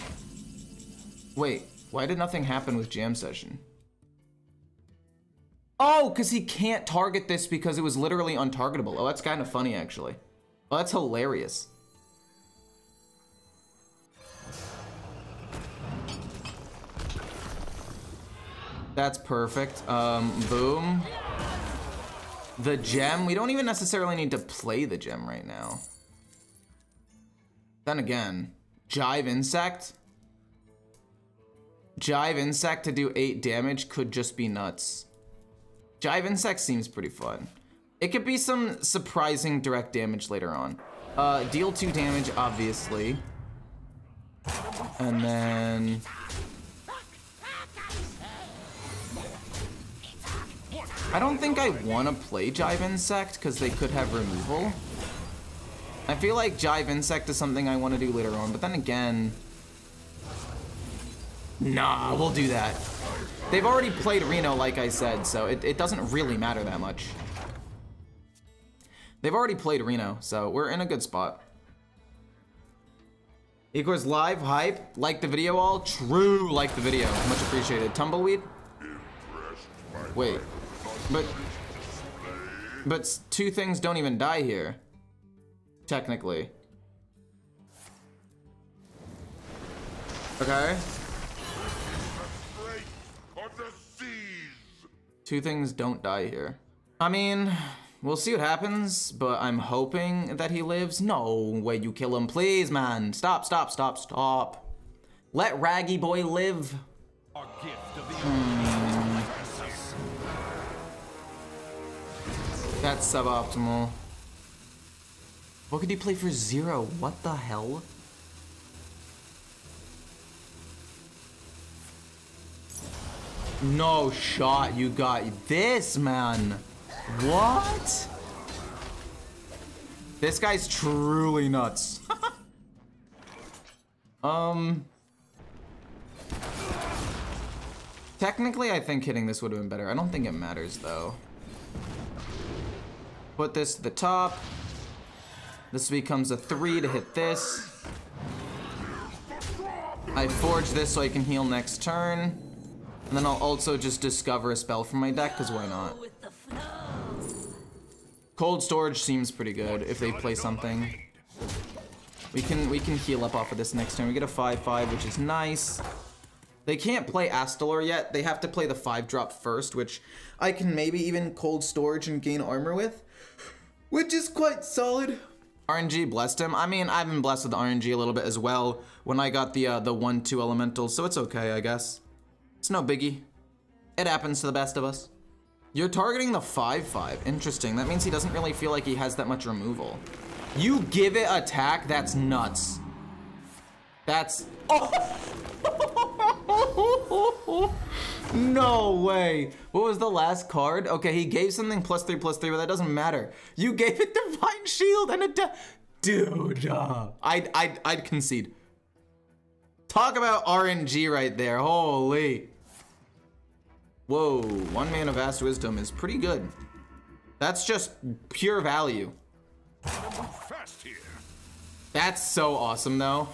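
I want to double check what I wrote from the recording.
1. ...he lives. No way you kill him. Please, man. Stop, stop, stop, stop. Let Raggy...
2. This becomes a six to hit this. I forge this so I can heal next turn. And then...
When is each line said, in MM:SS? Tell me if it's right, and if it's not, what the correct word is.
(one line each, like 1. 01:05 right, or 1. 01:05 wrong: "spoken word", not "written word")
1. 01:40 right
2. 02:25 wrong: "three", not "six".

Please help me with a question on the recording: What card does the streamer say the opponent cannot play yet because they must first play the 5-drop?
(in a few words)
Astalor.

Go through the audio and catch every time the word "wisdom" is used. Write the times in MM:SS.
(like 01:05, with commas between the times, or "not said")
03:35.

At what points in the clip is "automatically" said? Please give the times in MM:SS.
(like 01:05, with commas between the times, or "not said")
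not said.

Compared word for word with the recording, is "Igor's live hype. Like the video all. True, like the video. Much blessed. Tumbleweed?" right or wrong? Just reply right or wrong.
wrong.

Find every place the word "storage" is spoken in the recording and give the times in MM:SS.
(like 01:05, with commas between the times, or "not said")
02:38, 02:51.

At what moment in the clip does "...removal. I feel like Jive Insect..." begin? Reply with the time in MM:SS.
00:54.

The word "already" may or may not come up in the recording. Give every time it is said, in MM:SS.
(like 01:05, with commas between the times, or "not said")
01:03, 01:09.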